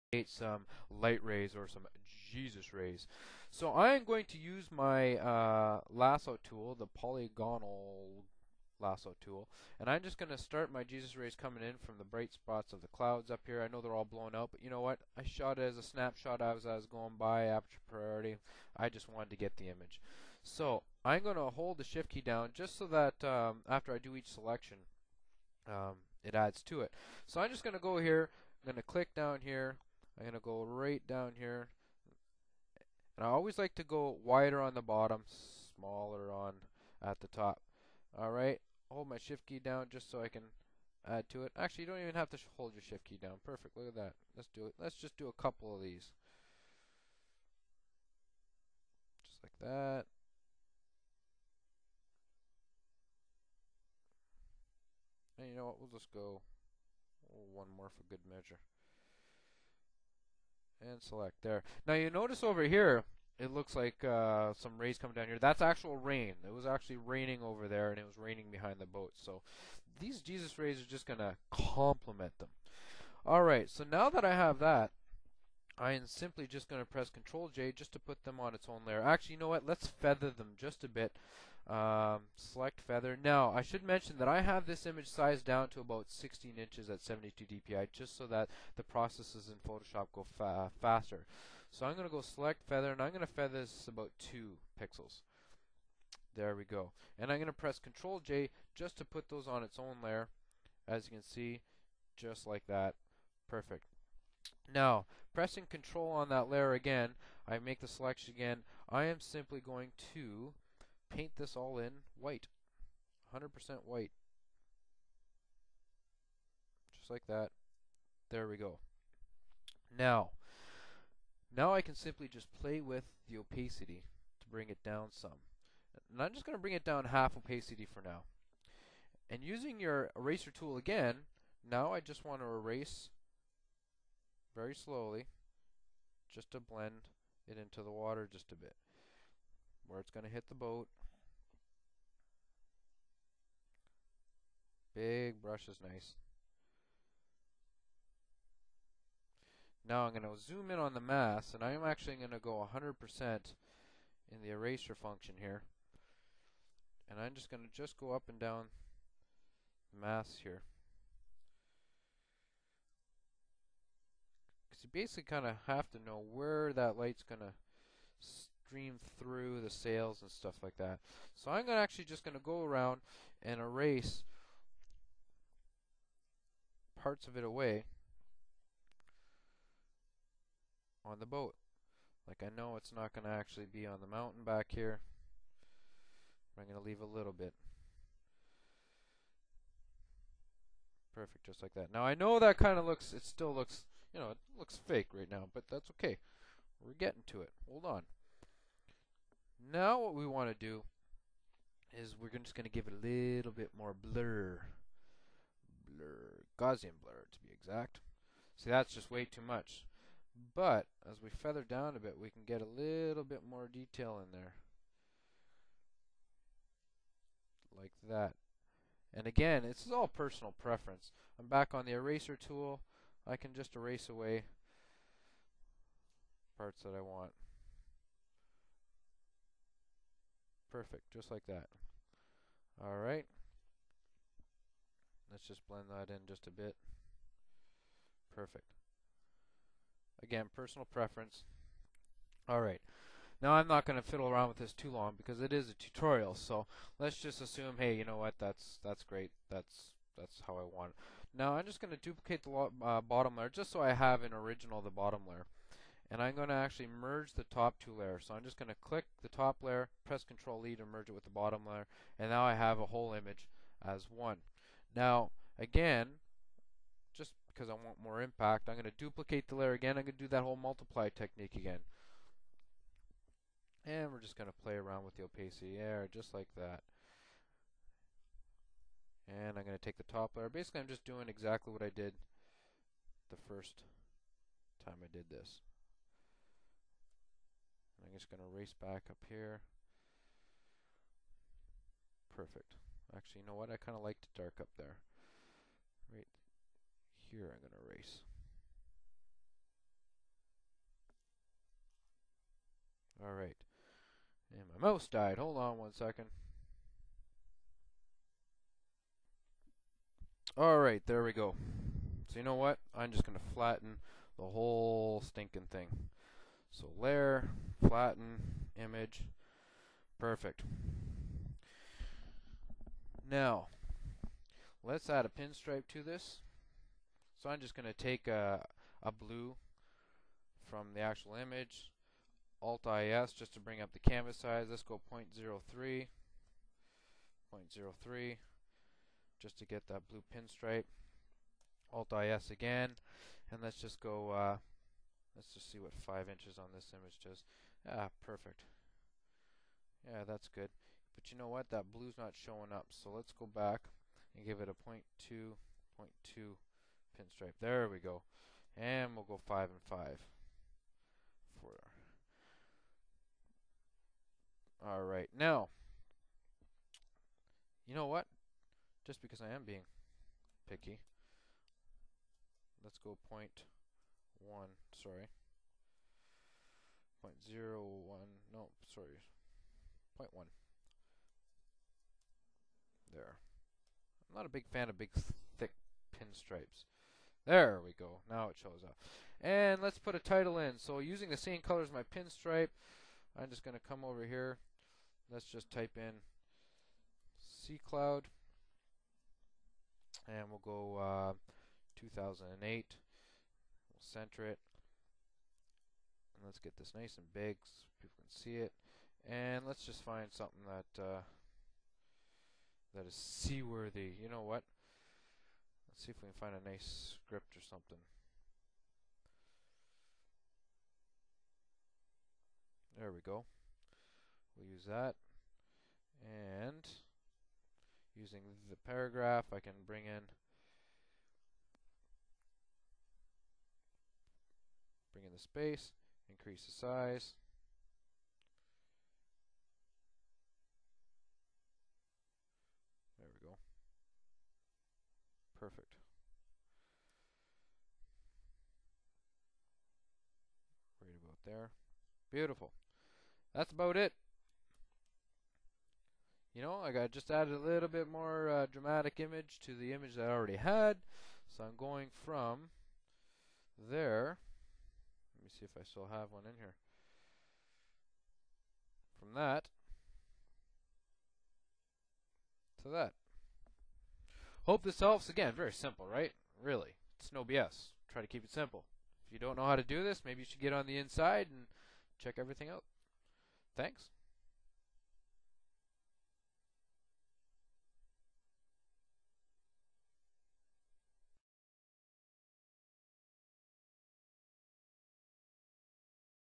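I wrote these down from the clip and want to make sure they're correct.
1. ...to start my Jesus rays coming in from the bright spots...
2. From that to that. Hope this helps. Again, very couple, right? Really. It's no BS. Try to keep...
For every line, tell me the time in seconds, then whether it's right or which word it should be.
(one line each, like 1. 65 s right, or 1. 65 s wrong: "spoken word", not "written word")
1. 10 s right
2. 469 s wrong: "simple", not "couple".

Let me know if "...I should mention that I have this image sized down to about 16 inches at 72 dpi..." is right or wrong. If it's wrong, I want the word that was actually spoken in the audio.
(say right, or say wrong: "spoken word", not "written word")
right.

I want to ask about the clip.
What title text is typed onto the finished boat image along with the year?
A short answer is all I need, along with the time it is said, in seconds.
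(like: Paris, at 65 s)
Sea Cloud, at 397 s.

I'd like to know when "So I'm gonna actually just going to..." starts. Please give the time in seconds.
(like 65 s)
171 s.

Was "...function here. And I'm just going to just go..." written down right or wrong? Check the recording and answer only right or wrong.
right.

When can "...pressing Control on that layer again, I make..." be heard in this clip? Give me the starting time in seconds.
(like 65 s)
105 s.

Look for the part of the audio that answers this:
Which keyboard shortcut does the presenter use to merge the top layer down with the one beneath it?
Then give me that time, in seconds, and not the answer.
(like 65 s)
260 s.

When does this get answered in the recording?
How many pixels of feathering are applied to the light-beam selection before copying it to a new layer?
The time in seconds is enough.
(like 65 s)
94 s.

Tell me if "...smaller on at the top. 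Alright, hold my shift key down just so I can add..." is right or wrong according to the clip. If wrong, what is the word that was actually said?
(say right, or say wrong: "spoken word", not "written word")
right.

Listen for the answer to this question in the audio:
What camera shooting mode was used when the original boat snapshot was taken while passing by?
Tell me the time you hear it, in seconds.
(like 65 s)
17 s.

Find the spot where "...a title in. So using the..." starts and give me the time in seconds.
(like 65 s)
390 s.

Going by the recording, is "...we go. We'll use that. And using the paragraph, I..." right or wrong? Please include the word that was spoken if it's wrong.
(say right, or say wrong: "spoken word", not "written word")
right.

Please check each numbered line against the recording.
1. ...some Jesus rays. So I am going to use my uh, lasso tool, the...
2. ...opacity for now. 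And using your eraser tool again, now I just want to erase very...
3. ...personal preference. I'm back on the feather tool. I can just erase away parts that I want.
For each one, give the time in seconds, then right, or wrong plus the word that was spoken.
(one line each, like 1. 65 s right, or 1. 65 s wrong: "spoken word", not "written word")
1. 1 s right
2. 127 s right
3. 220 s wrong: "eraser", not "feather".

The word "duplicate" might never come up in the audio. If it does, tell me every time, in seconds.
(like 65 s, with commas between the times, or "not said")
251 s, 268 s.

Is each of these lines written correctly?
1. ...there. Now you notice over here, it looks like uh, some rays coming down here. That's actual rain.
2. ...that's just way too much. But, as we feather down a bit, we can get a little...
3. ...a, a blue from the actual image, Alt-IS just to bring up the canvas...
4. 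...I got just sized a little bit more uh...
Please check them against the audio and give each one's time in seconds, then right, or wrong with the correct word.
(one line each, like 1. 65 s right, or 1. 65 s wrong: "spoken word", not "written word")
1. 61 s right
2. 208 s right
3. 328 s right
4. 456 s wrong: "added", not "sized".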